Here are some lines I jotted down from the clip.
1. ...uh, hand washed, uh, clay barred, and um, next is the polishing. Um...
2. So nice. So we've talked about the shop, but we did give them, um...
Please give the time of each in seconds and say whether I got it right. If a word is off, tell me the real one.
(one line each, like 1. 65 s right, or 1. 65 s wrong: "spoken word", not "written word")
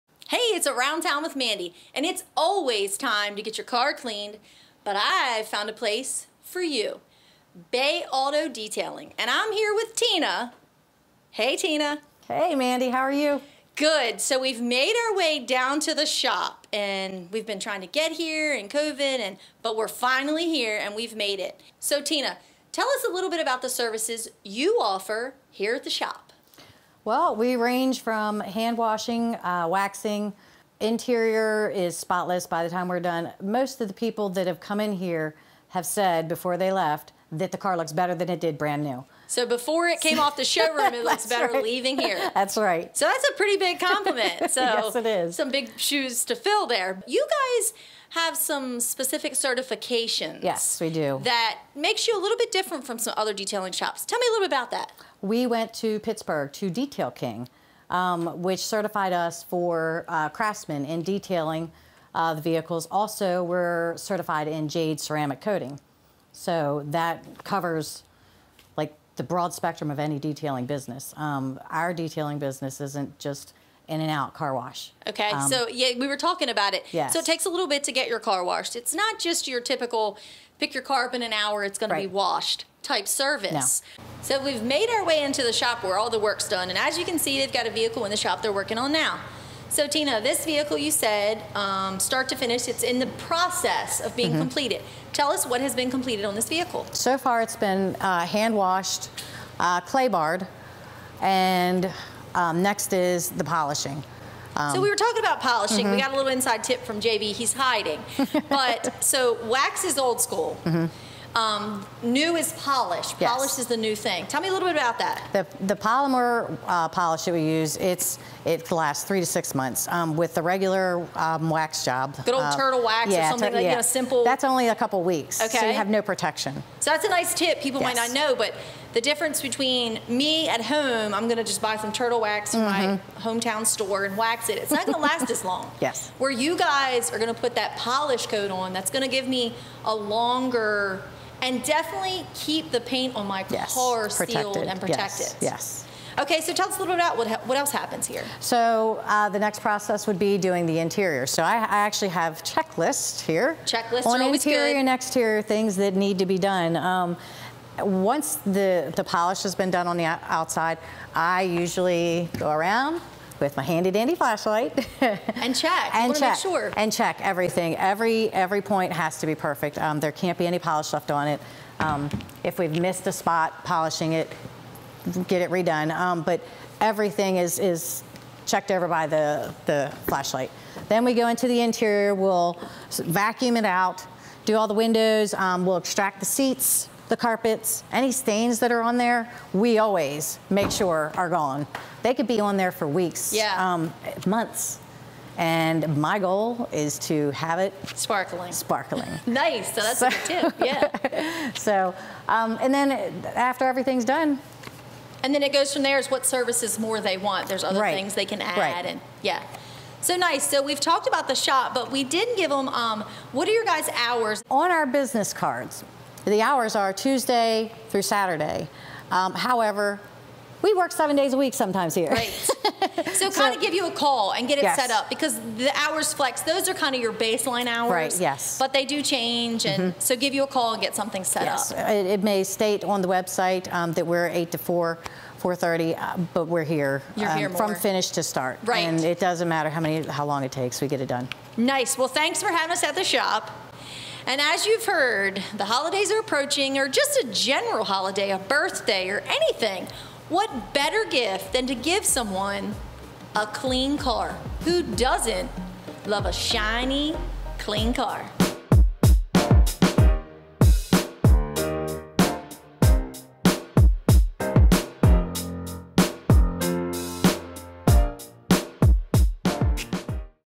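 1. 98 s right
2. 209 s right.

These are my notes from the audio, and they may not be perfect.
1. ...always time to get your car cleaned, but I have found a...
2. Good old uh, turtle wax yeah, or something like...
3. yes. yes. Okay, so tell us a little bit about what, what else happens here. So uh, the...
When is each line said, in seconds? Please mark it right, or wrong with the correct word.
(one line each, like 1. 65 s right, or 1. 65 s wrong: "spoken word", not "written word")
1. 2 s right
2. 122 s right
3. 145 s right.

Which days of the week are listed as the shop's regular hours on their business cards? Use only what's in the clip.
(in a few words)
Tuesday through Saturday.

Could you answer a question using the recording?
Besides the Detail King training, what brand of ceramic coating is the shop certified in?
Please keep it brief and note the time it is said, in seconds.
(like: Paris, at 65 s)
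Jade, at 64 s.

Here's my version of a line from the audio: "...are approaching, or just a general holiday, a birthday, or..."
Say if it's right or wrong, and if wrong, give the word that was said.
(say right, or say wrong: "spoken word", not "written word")
right.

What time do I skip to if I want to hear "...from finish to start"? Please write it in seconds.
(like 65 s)
237 s.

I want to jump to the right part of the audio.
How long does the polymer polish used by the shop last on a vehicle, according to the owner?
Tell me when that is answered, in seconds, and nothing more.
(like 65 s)
119 s.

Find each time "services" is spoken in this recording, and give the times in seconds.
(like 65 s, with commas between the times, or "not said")
23 s, 83 s, 206 s.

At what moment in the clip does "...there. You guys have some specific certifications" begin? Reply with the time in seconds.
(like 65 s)
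46 s.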